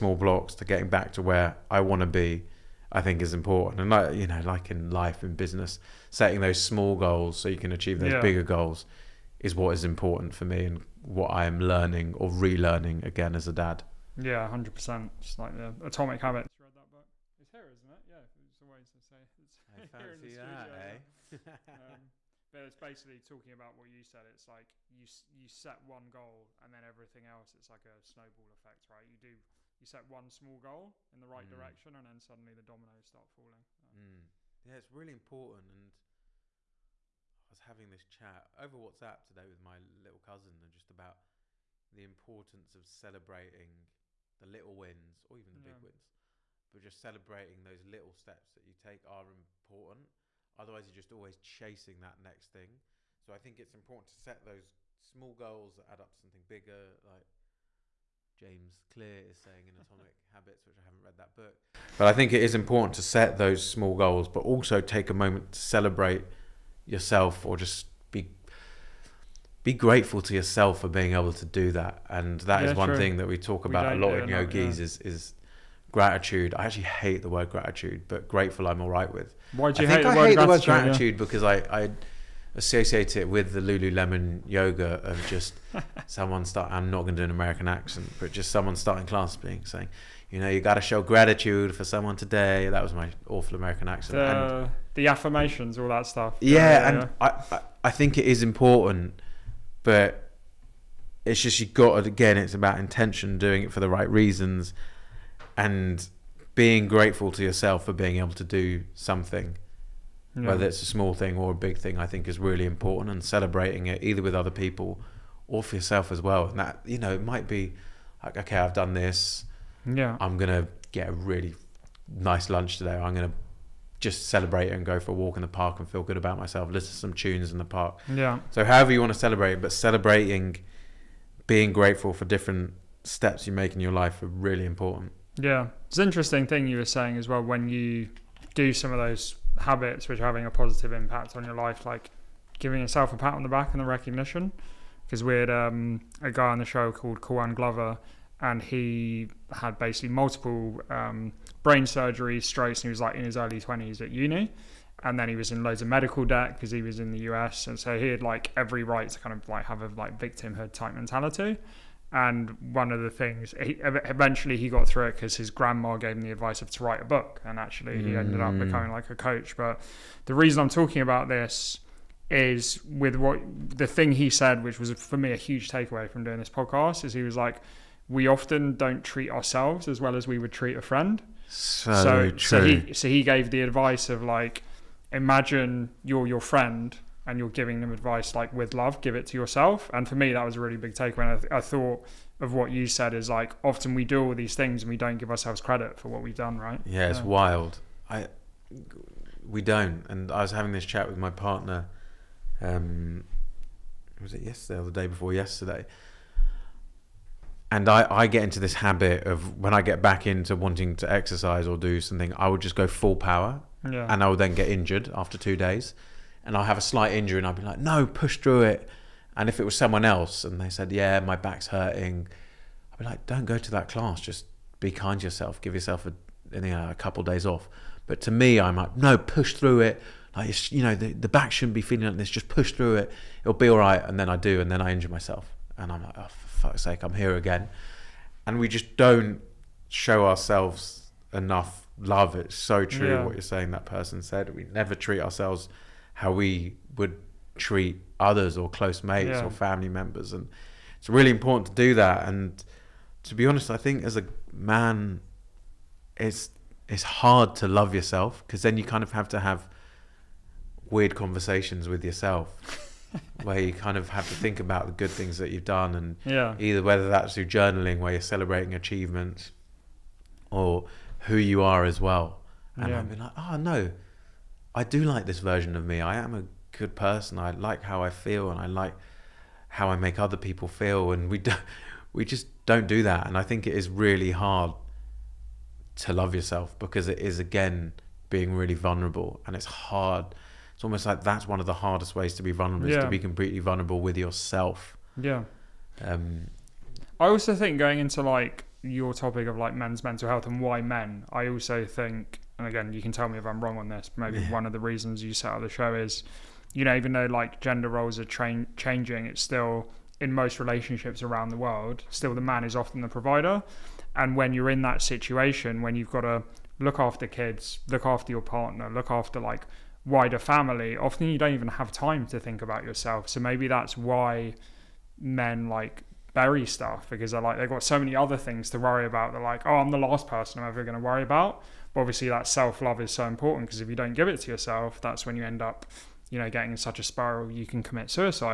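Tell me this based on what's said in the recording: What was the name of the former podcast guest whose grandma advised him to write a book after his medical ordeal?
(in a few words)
Kwan Glover.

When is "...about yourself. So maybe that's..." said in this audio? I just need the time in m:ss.
5:22.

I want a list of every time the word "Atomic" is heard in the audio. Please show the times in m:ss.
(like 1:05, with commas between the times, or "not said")
0:15, 0:59.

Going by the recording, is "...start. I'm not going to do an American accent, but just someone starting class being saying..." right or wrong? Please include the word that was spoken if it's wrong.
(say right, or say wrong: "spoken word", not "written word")
right.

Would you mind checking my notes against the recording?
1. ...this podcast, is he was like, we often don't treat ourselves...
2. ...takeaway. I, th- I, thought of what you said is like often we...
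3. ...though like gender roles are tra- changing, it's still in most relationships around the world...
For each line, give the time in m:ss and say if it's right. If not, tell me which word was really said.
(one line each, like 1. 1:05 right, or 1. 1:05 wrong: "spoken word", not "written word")
1. 2:56 right
2. 3:10 right
3. 5:07 right.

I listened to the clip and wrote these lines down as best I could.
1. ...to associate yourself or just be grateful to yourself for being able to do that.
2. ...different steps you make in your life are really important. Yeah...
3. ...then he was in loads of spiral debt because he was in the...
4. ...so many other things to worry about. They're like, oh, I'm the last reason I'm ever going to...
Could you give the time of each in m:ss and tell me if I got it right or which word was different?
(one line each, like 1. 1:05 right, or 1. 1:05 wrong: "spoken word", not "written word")
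1. 1:05 wrong: "celebrate", not "associate"
2. 2:12 right
3. 2:35 wrong: "medical", not "spiral"
4. 5:27 wrong: "person", not "reason".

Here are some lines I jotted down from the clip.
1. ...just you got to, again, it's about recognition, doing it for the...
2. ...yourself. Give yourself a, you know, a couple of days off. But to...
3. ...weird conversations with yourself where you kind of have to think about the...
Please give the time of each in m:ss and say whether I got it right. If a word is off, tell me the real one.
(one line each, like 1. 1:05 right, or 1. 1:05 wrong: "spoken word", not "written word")
1. 1:41 wrong: "intention", not "recognition"
2. 3:45 right
3. 4:20 right.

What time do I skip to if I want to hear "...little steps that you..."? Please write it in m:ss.
0:47.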